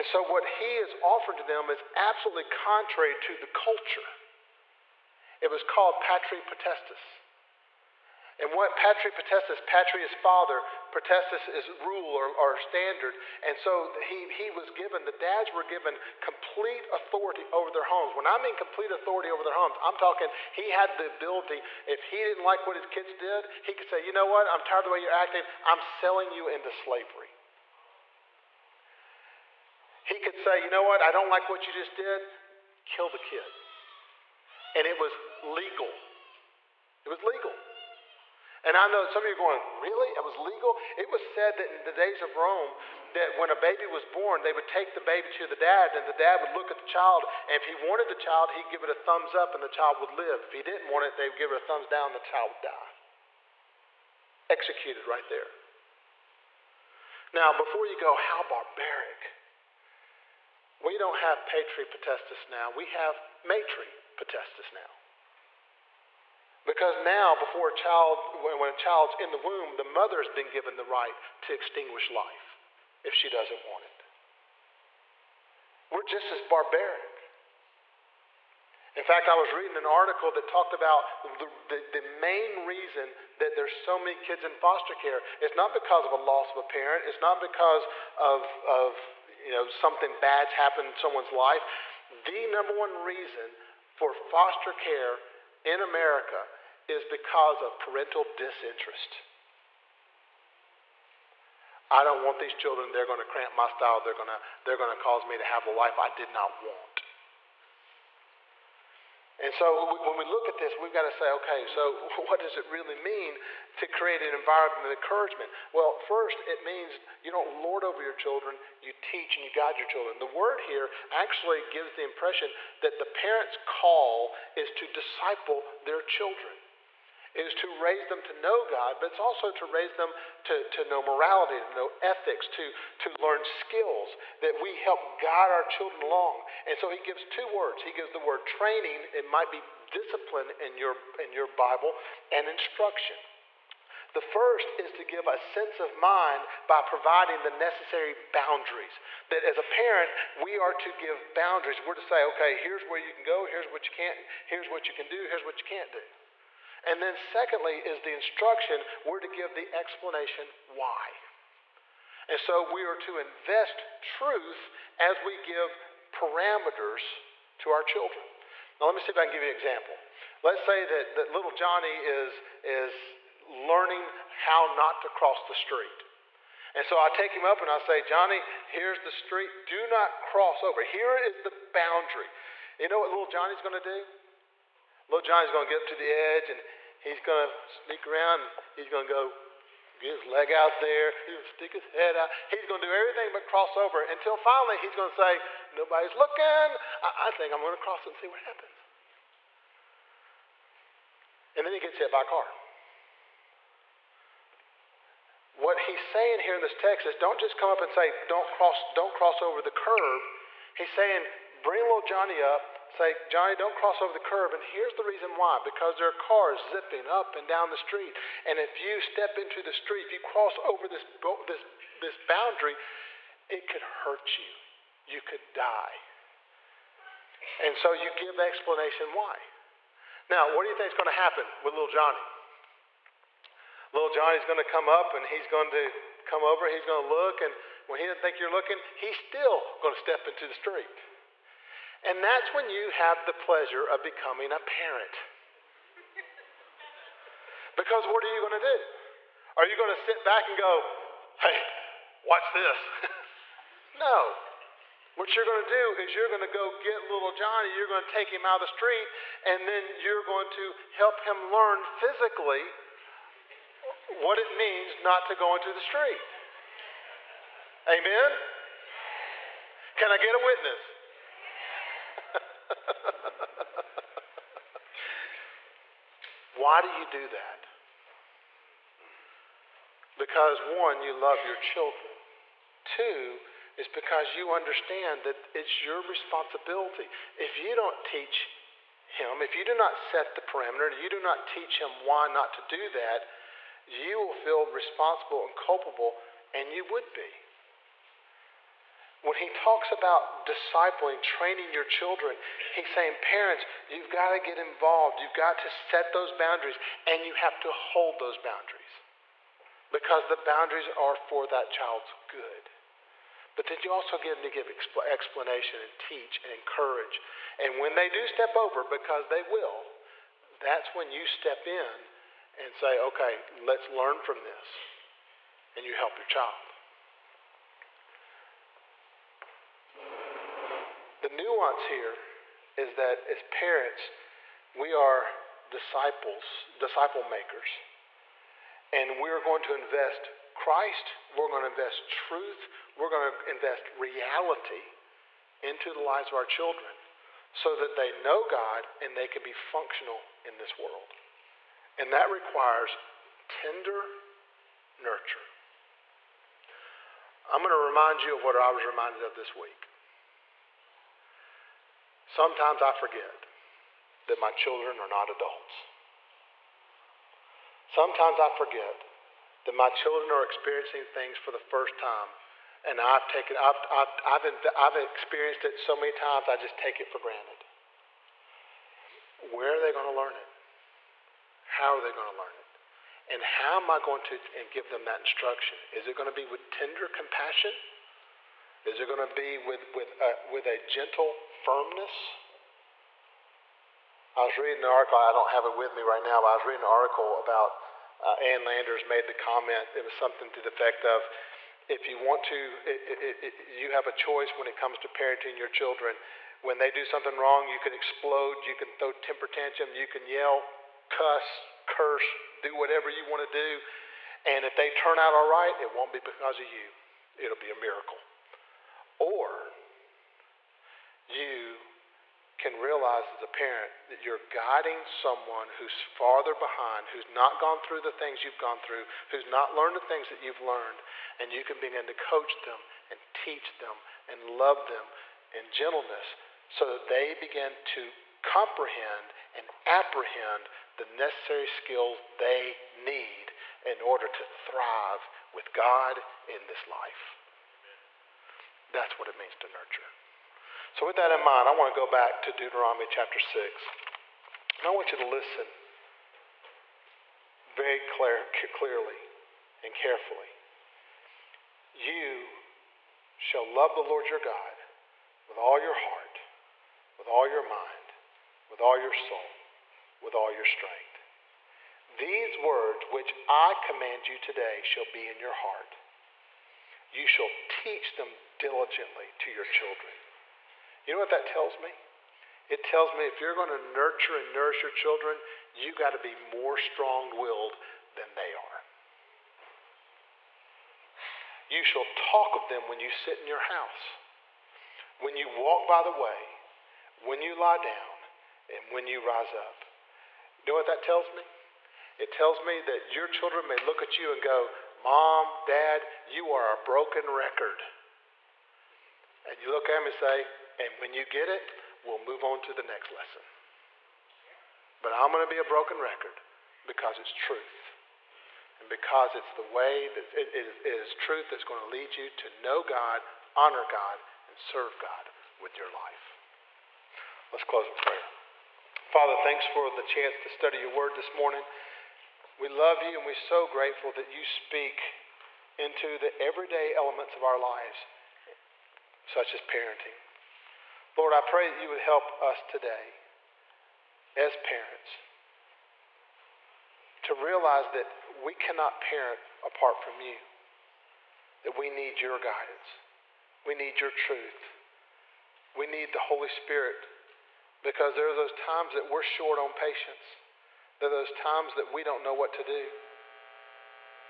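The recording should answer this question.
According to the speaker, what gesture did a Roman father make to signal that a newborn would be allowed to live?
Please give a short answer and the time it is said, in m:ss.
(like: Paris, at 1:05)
thumbs up, at 0:48.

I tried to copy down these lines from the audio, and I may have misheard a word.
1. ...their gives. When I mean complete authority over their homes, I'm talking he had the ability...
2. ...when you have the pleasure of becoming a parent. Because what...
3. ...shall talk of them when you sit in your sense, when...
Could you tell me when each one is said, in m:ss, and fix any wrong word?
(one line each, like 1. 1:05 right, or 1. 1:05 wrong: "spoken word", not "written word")
1. 0:17 wrong: "homes", not "gives"
2. 4:02 right
3. 8:11 wrong: "house", not "sense".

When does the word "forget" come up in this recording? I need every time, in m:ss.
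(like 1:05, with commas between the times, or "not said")
6:02, 6:08.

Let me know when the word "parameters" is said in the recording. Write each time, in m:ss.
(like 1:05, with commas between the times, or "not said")
2:46, 4:50.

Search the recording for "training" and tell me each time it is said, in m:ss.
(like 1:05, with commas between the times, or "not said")
2:18, 5:01.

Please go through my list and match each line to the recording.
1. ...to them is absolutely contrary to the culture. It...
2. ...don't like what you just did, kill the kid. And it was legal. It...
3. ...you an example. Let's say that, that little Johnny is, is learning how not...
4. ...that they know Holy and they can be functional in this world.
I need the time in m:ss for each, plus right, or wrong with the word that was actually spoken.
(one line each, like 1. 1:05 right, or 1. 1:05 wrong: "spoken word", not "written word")
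1. 0:01 right
2. 0:31 right
3. 2:49 right
4. 5:47 wrong: "God", not "Holy".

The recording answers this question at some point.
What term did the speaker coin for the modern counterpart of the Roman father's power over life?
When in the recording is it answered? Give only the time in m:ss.
1:03.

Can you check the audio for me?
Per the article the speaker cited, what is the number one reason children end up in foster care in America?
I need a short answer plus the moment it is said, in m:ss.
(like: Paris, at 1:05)
parental disinterest, at 1:37.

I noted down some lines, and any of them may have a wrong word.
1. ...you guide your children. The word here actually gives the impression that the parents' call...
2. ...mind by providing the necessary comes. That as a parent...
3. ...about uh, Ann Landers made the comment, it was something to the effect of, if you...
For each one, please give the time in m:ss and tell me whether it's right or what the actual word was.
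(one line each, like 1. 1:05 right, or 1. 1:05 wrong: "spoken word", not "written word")
1. 1:59 right
2. 2:25 wrong: "boundaries", not "comes"
3. 6:37 right.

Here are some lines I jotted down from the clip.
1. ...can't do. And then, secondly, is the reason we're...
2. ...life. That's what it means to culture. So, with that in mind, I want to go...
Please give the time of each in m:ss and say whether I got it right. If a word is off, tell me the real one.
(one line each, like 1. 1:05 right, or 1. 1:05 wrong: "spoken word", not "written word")
1. 2:35 wrong: "instruction", not "reason"
2. 7:26 wrong: "nurture", not "culture".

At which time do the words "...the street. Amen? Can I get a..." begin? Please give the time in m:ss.
4:25.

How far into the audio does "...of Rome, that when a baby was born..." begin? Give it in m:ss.
0:42.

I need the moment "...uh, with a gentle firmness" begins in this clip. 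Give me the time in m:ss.
6:30.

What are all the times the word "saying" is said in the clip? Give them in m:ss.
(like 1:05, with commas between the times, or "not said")
3:26, 3:30, 5:02.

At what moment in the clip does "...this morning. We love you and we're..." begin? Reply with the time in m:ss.
8:51.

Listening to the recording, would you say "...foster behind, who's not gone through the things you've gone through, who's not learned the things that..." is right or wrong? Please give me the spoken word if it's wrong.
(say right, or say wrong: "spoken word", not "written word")
wrong: "farther", not "foster".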